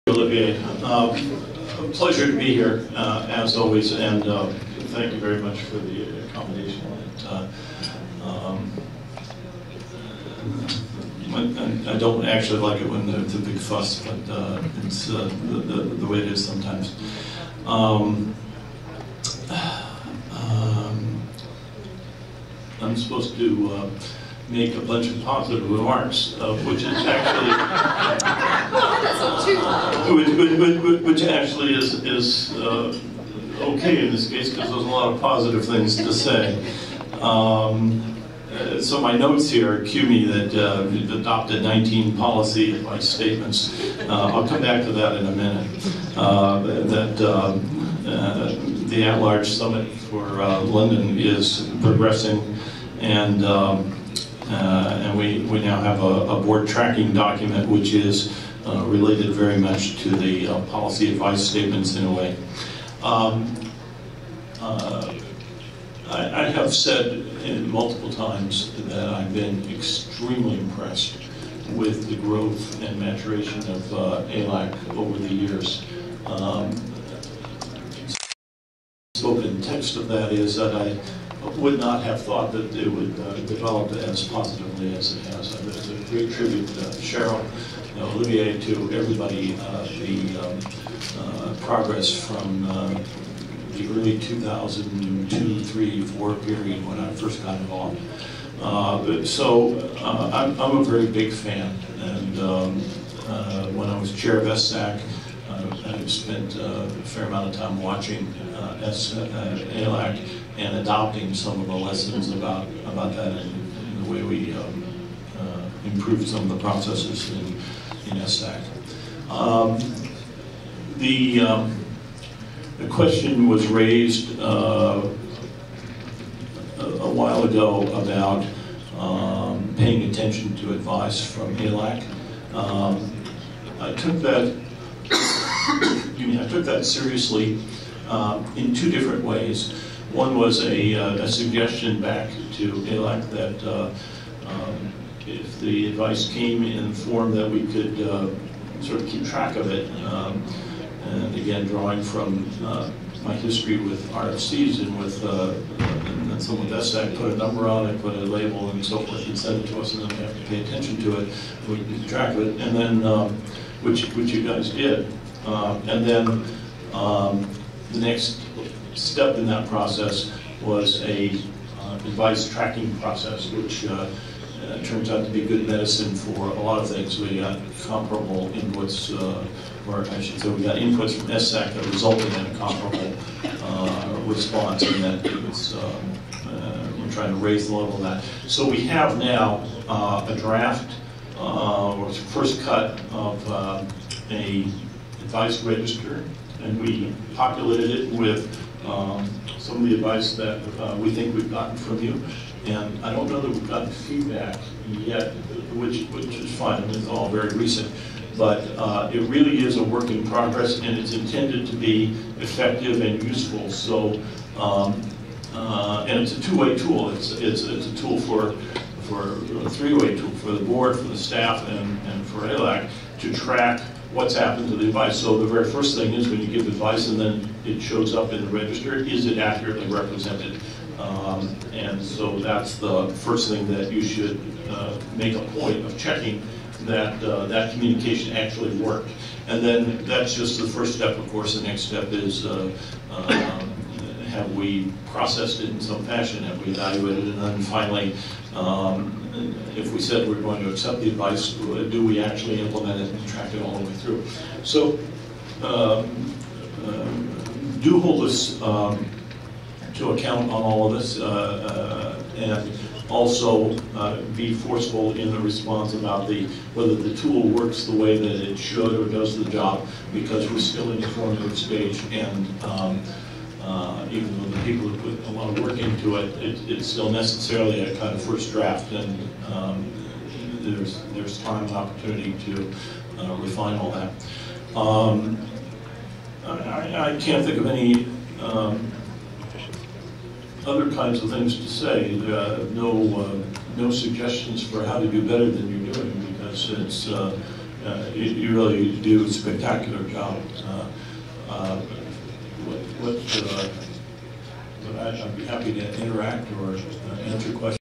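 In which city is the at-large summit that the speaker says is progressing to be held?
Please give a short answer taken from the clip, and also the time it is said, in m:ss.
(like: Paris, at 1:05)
London, at 0:50.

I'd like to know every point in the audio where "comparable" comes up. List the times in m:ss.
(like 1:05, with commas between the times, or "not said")
2:57, 3:02.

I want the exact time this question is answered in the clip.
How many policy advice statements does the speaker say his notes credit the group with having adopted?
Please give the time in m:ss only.
0:41.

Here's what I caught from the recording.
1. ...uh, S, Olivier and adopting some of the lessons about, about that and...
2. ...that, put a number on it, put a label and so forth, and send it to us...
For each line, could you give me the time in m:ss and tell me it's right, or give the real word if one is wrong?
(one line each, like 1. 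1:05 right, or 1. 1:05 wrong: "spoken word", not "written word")
1. 1:48 wrong: "ALAC", not "Olivier"
2. 2:36 right.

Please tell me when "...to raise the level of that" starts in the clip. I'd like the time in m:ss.
3:07.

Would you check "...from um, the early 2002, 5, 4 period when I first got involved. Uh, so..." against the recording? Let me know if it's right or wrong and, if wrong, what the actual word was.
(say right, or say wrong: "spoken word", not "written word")
wrong: "3", not "5".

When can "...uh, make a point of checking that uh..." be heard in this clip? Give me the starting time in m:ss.
3:54.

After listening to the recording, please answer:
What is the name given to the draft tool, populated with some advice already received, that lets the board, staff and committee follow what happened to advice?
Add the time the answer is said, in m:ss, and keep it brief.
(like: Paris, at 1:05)
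advice register, at 3:15.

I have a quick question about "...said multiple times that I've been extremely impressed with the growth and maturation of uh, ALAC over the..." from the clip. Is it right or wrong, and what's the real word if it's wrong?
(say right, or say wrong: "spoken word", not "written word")
right.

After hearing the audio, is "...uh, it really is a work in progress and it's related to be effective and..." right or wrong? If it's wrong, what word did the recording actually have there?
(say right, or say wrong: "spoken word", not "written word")
wrong: "intended", not "related".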